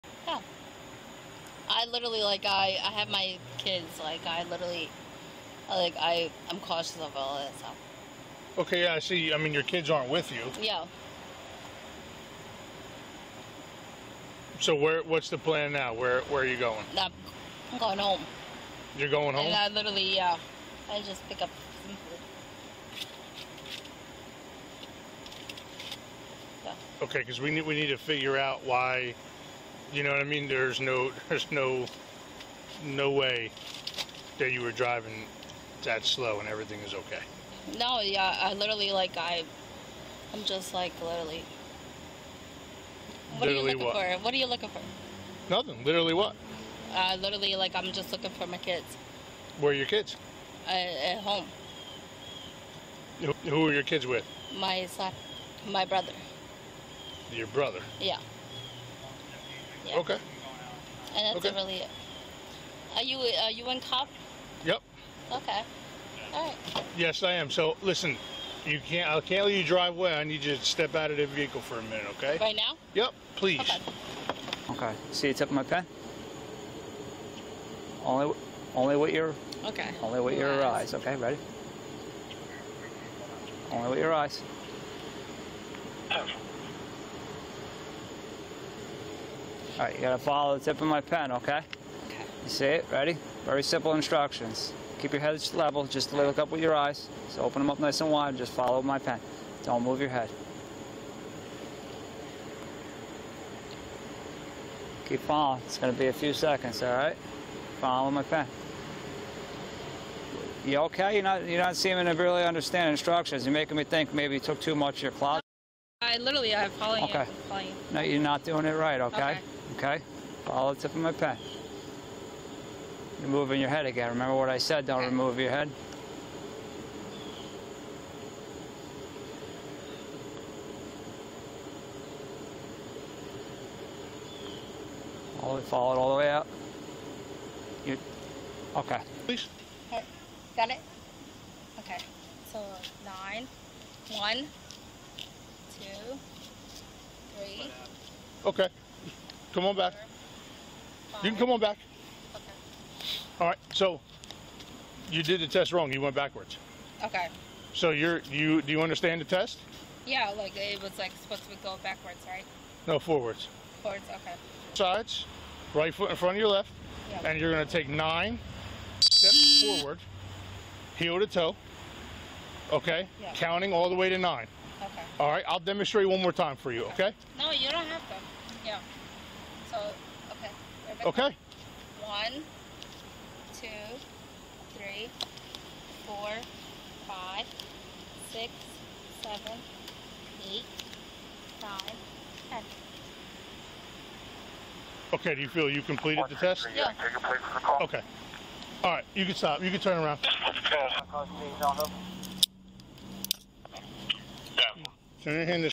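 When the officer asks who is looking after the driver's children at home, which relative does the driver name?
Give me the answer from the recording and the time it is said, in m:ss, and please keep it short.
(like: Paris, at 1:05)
my brother, at 0:55.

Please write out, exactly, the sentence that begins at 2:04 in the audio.
Remember what I said, don't remove your head.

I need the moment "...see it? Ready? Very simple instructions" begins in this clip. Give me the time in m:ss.
1:32.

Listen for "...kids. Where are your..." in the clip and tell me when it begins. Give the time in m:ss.
0:48.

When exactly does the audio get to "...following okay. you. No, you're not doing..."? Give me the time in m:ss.
1:56.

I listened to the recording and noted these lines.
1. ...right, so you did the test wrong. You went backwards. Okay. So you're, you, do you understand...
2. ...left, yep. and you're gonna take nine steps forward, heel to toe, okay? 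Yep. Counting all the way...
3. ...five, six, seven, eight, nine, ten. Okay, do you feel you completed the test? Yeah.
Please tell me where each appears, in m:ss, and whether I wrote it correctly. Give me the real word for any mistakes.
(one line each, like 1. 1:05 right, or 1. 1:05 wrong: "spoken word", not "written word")
1. 2:33 right
2. 2:46 right
3. 3:07 right.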